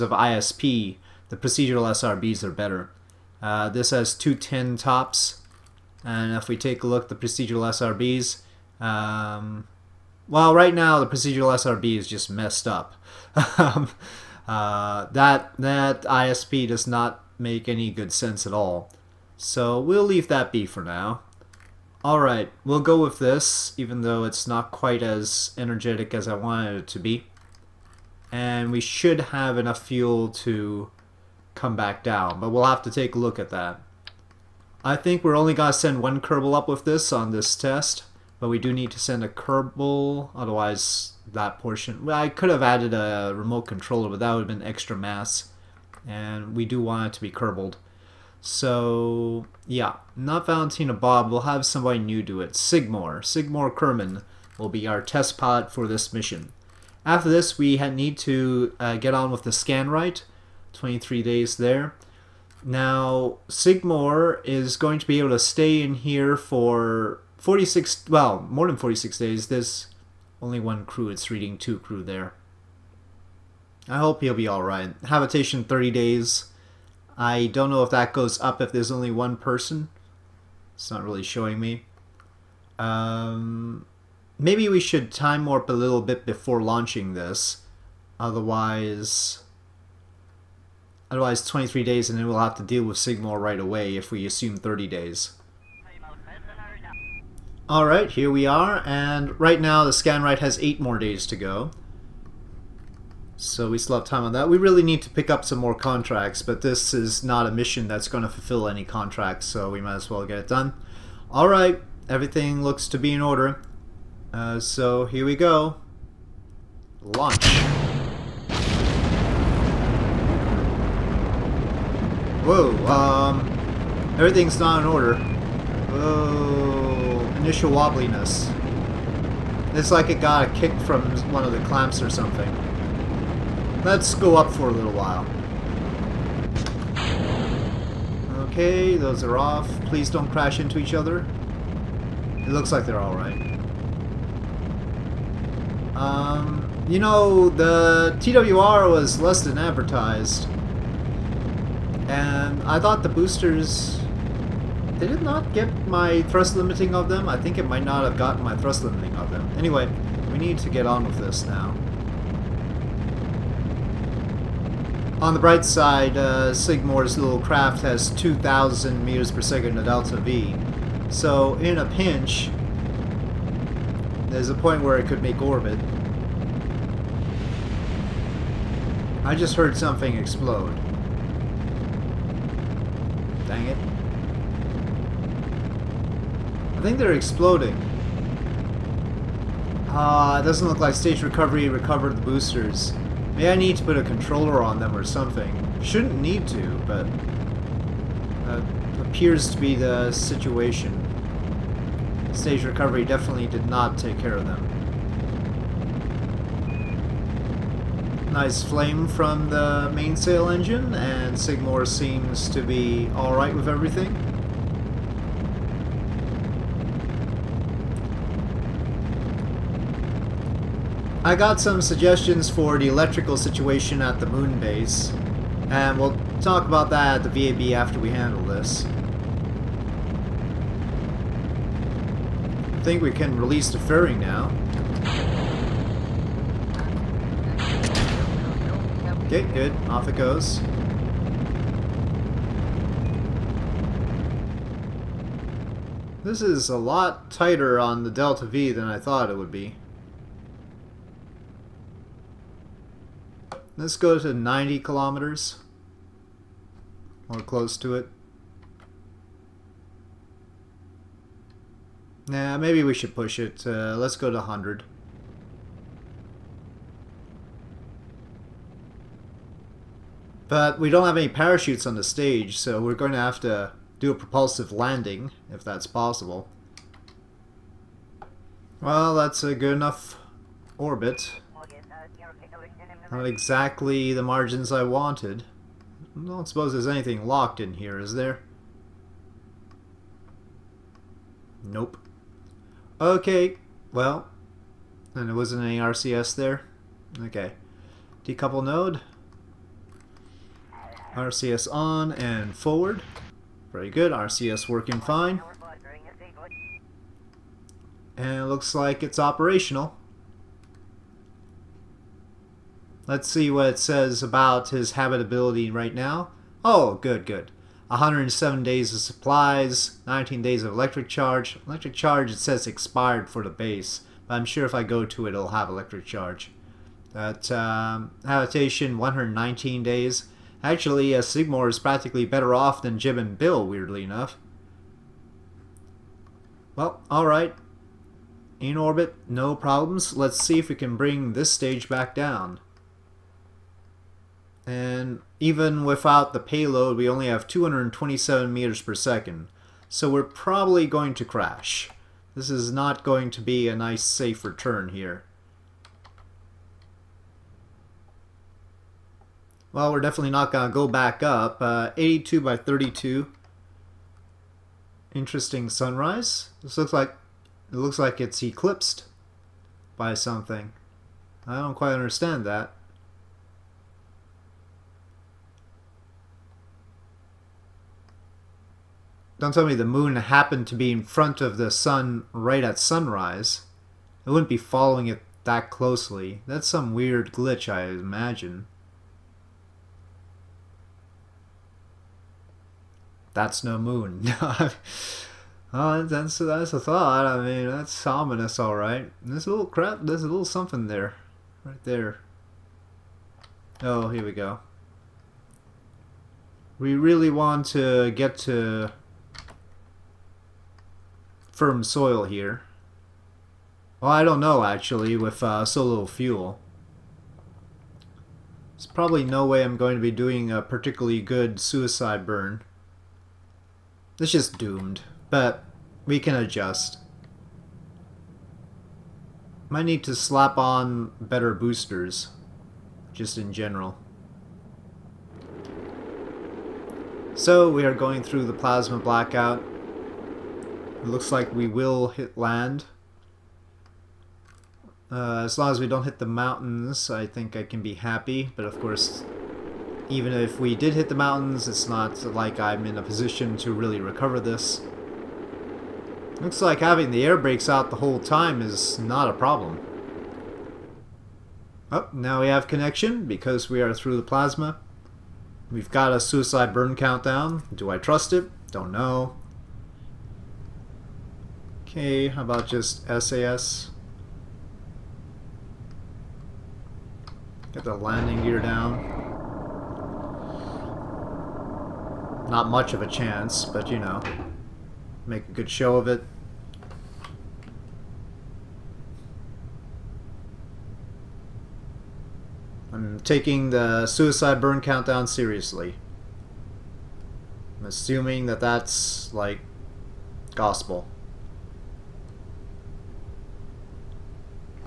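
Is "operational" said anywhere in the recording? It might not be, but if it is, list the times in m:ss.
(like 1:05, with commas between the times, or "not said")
5:09.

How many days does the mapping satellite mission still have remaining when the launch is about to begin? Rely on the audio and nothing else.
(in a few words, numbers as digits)
8.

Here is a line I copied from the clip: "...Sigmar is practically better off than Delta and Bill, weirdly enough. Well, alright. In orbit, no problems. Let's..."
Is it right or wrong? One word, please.
wrong.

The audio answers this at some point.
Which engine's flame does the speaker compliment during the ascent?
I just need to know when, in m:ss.
3:29.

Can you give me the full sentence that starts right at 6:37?
I mean, that's ominous, all right.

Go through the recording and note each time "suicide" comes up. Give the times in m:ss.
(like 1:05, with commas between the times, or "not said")
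7:01, 7:46, 8:14.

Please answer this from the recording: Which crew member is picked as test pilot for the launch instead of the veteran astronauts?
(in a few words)
Sigmore Kerman.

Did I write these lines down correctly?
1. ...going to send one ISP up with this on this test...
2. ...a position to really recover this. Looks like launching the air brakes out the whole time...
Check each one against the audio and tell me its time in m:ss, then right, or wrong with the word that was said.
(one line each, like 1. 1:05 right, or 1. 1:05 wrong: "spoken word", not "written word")
1. 0:35 wrong: "Kerbal", not "ISP"
2. 7:32 wrong: "having", not "launching".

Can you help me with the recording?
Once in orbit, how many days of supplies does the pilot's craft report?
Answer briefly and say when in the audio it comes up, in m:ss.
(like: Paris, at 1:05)
107, at 5:17.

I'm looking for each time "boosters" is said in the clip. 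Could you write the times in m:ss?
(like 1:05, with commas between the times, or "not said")
2:33, 3:12, 7:11.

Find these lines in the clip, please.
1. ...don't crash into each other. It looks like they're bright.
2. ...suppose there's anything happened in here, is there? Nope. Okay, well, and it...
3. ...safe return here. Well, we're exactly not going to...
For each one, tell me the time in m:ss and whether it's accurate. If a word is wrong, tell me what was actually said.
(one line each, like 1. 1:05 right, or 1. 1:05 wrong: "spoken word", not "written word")
1. 2:20 wrong: "alright", not "bright"
2. 4:46 wrong: "locked", not "happened"
3. 5:54 wrong: "definitely", not "exactly".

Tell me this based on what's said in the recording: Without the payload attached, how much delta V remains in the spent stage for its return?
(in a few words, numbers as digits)
227 meters per second.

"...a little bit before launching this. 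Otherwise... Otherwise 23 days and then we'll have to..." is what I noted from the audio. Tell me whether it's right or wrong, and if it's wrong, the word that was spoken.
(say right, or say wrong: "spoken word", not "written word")
right.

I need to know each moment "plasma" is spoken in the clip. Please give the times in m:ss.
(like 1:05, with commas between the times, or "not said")
7:18, 7:44.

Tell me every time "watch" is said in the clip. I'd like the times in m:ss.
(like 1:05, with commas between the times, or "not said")
not said.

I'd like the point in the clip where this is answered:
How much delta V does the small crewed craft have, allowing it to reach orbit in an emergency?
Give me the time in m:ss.
2:48.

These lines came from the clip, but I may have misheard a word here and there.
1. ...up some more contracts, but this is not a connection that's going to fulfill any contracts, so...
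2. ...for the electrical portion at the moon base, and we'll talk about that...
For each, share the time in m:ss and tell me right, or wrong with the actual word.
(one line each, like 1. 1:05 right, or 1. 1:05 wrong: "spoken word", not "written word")
1. 1:45 wrong: "mission", not "connection"
2. 3:42 wrong: "situation", not "portion".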